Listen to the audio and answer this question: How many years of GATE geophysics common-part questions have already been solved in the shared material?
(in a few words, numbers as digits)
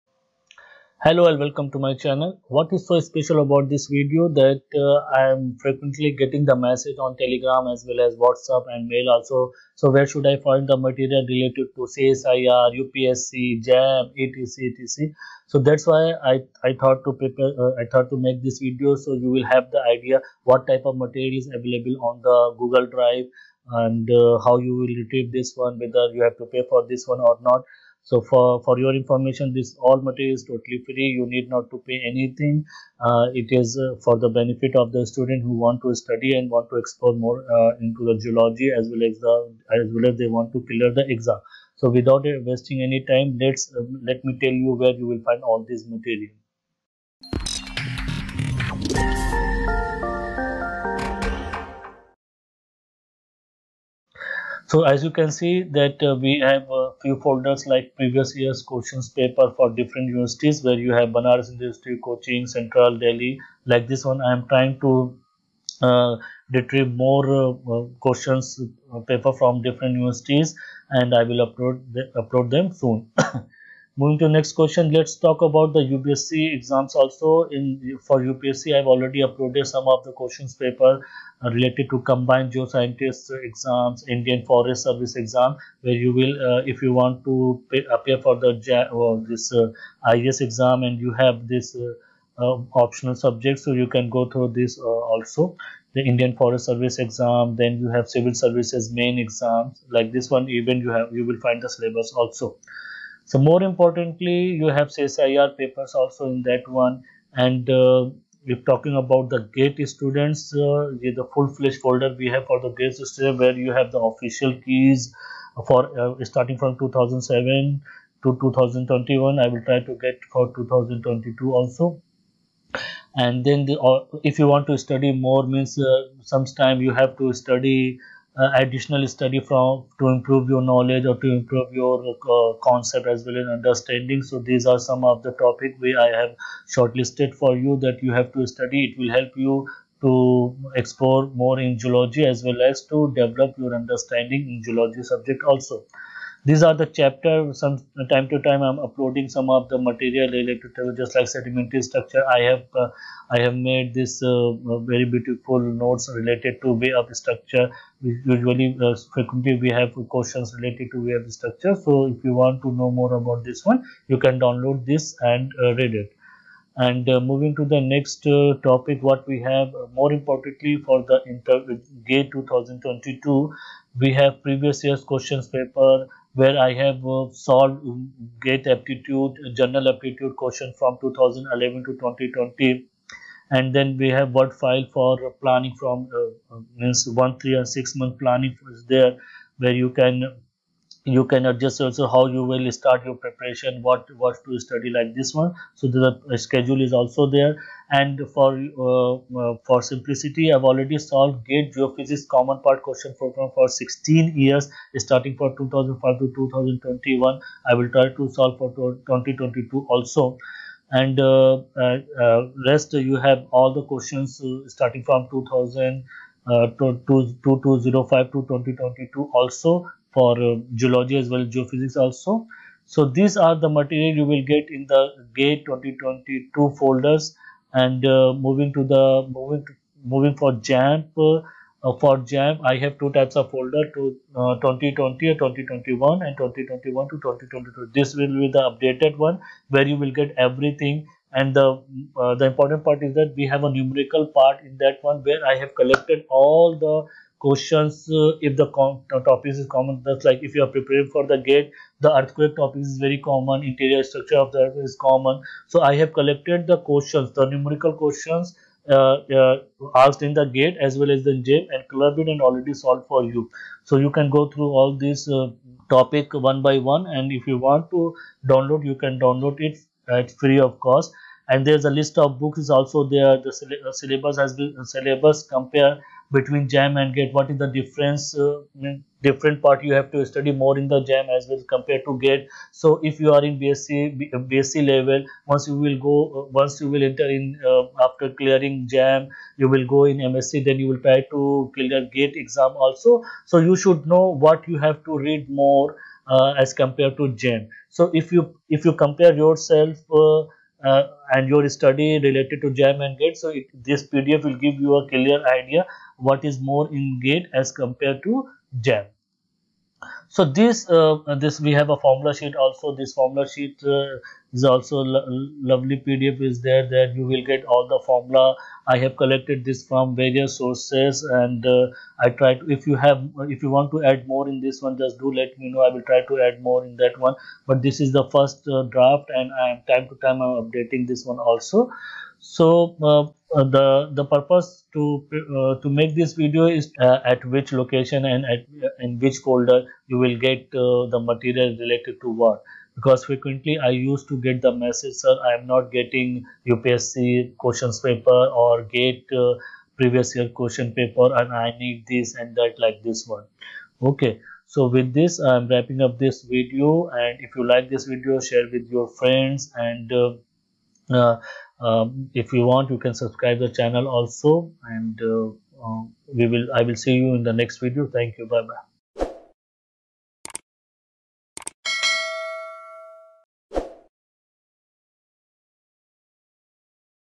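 16.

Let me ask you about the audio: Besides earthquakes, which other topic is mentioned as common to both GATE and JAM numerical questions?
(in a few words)
interior structure of the earth.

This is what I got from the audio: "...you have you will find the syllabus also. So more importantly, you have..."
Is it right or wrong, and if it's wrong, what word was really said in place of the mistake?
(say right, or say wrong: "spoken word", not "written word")
right.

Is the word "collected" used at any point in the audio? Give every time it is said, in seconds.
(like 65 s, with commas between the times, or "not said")
245 s, 256 s, 319 s.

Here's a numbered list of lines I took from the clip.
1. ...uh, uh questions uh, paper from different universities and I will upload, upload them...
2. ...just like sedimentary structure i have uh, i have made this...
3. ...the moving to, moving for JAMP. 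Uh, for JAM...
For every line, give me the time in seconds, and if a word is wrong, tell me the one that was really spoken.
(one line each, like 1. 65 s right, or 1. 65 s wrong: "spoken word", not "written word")
1. 67 s right
2. 150 s right
3. 228 s right.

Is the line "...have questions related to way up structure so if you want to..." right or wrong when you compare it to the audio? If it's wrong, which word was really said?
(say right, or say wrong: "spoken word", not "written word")
right.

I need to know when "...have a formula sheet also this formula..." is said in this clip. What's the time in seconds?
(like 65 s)
311 s.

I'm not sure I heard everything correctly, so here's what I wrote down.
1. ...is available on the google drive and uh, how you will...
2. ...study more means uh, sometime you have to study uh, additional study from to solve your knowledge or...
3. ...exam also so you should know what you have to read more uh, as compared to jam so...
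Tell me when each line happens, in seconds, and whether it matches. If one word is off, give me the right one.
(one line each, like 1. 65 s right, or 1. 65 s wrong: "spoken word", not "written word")
1. 21 s right
2. 124 s wrong: "improve", not "solve"
3. 292 s right.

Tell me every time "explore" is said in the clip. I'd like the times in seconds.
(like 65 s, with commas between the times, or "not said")
36 s, 140 s.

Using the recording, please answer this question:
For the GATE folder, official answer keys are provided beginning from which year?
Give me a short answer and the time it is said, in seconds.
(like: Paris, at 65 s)
2007, at 116 s.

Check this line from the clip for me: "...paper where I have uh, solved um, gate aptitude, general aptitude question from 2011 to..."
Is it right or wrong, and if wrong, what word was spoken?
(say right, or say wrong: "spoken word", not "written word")
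right.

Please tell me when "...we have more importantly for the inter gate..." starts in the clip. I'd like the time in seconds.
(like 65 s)
169 s.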